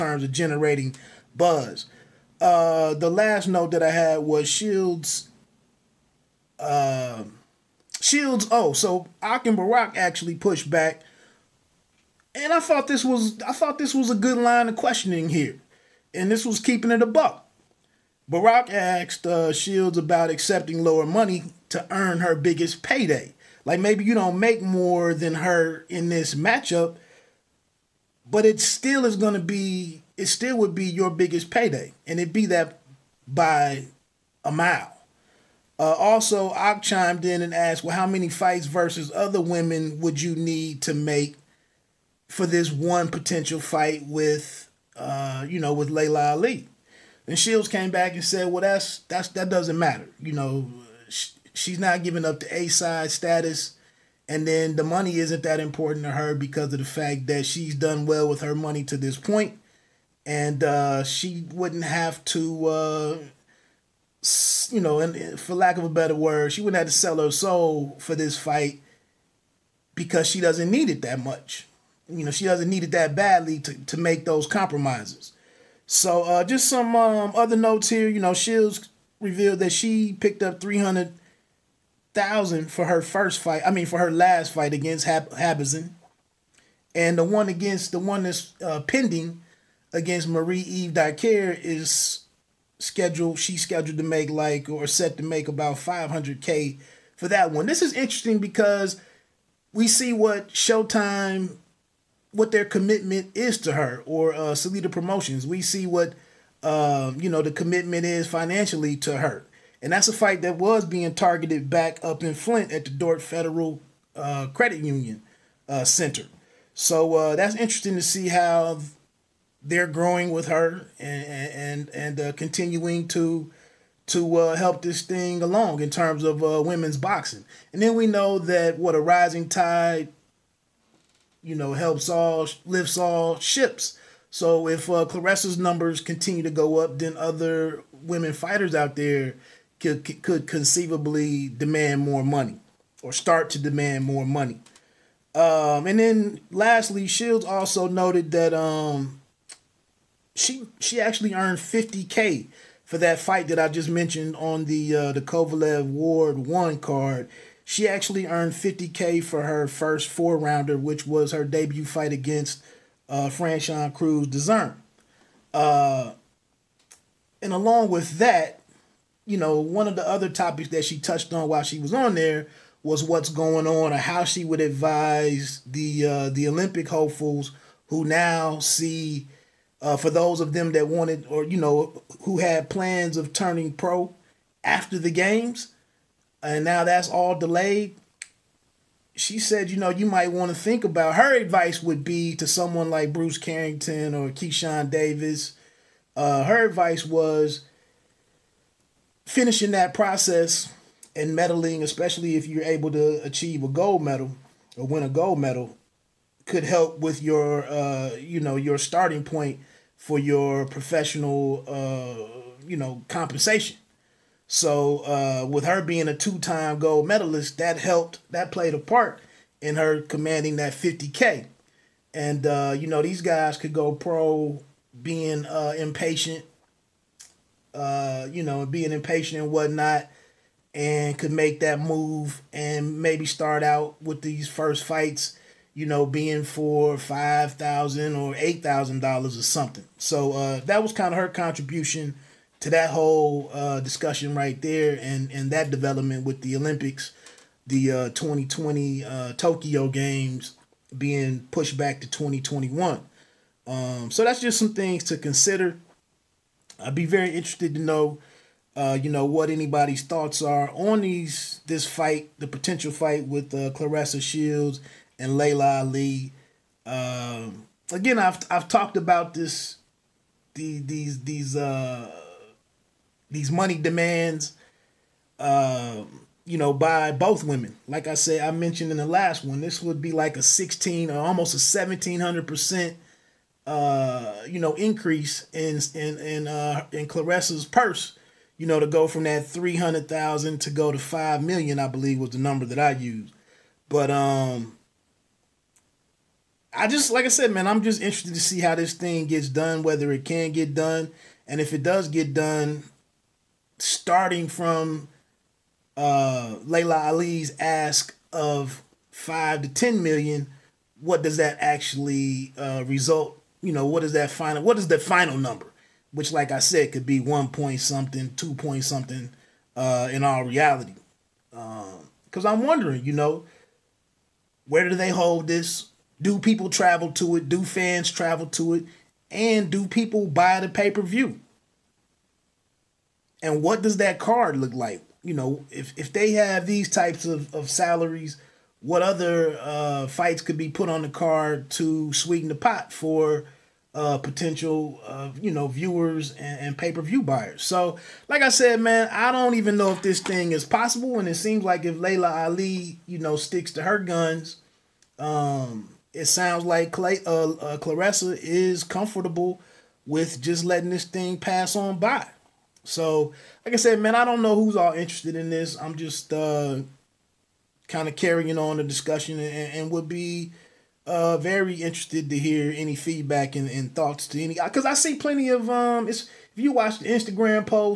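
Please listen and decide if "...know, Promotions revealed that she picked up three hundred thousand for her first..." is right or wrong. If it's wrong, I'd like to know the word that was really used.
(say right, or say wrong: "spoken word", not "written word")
wrong: "Shields", not "Promotions".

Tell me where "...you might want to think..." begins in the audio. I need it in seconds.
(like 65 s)
189 s.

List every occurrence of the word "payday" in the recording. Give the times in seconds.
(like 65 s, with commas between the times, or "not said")
22 s, 31 s.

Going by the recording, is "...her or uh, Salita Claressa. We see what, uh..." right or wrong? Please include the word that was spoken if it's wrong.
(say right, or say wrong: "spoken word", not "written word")
wrong: "Promotions", not "Claressa".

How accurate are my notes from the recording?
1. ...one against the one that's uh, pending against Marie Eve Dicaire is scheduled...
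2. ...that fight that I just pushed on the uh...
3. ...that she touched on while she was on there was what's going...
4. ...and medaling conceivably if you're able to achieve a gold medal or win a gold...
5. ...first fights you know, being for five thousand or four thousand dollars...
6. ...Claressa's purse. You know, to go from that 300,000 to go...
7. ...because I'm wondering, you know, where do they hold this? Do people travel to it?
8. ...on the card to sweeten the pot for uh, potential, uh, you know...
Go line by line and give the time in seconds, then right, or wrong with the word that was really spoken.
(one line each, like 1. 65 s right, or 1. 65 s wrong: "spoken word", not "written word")
1. 87 s right
2. 152 s wrong: "mentioned", not "pushed"
3. 170 s right
4. 201 s wrong: "especially", not "conceivably"
5. 234 s wrong: "eight", not "four"
6. 287 s right
7. 322 s right
8. 340 s right.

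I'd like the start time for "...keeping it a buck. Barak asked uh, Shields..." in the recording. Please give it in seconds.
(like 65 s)
16 s.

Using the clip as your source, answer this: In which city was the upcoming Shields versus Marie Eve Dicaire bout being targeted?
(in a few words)
Flint.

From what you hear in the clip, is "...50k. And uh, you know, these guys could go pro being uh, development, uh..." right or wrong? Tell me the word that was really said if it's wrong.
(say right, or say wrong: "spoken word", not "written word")
wrong: "impatient", not "development".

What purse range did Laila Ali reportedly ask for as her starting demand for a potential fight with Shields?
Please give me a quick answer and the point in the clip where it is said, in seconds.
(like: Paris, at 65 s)
5 to 10 million, at 309 s.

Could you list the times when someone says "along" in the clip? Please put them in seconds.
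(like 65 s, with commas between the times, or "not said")
125 s, 167 s.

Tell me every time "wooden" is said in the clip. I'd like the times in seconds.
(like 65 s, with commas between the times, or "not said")
not said.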